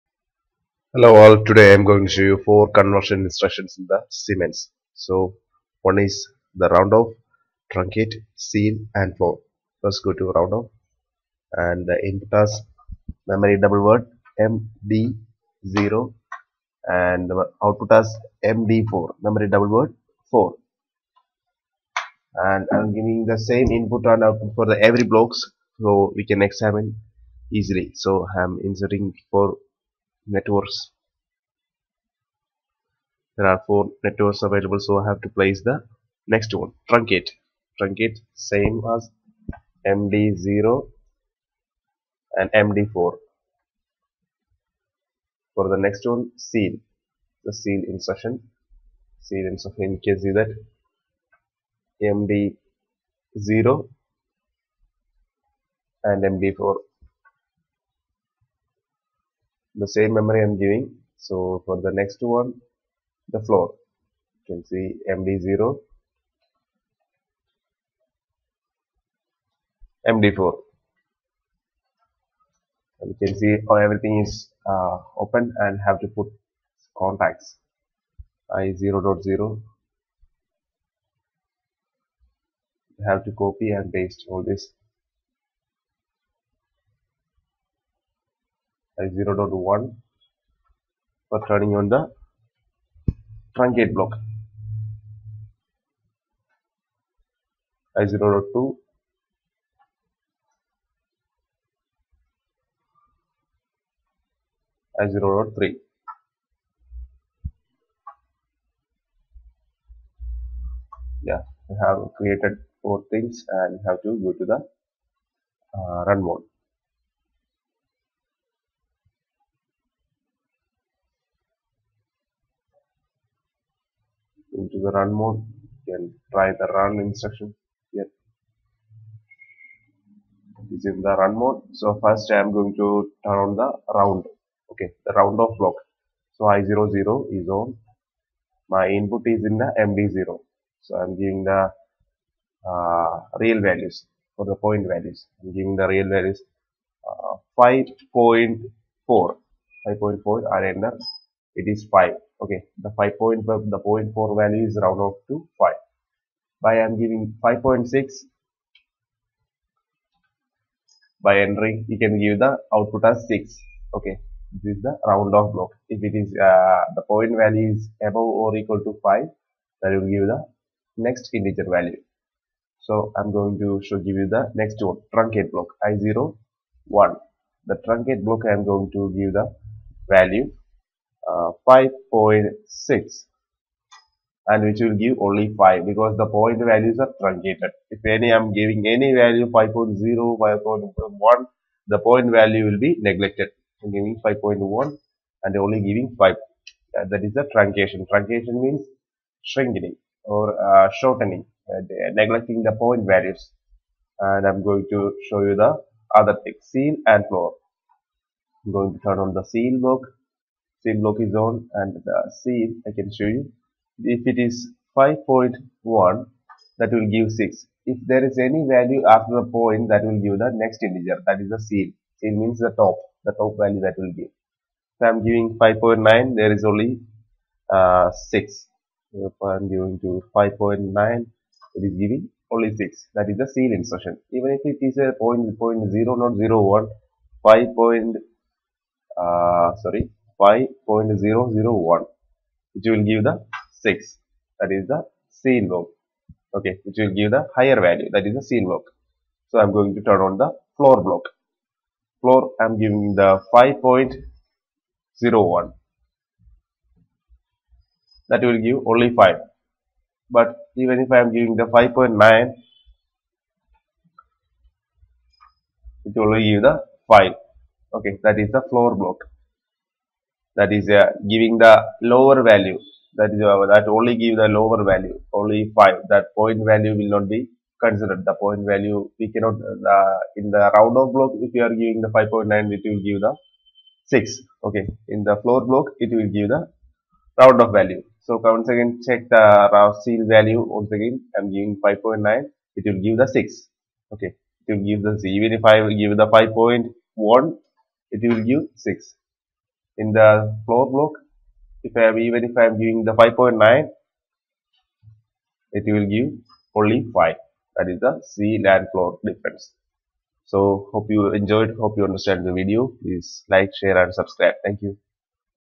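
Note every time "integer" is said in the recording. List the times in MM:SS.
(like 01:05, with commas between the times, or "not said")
02:51, 03:40.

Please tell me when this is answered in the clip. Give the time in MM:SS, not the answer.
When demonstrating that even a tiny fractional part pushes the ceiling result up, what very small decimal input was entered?
04:00.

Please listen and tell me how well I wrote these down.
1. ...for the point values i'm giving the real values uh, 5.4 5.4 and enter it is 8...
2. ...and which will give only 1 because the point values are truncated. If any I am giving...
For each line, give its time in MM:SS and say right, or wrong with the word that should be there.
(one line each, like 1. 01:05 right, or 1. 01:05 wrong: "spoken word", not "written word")
1. 02:24 wrong: "5", not "8"
2. 03:04 wrong: "5", not "1".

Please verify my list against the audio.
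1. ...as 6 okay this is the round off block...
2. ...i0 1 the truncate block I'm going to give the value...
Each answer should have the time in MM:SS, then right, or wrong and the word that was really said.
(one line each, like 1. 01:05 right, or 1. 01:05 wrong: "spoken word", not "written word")
1. 02:43 right
2. 02:55 right.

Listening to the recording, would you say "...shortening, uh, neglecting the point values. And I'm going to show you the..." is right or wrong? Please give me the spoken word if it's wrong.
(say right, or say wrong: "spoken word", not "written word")
right.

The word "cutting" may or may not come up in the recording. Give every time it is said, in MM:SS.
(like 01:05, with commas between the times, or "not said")
not said.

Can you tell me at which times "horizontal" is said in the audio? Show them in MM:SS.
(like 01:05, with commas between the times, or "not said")
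not said.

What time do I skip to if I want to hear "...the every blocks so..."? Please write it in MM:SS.
00:24.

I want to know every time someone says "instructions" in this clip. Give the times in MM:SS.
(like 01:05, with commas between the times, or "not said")
00:03, 02:07.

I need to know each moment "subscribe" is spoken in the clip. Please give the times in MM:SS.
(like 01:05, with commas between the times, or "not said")
05:14.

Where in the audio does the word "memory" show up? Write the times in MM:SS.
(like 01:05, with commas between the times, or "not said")
00:13, 00:19, 01:00.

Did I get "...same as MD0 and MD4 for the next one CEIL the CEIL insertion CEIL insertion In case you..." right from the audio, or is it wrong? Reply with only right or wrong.
right.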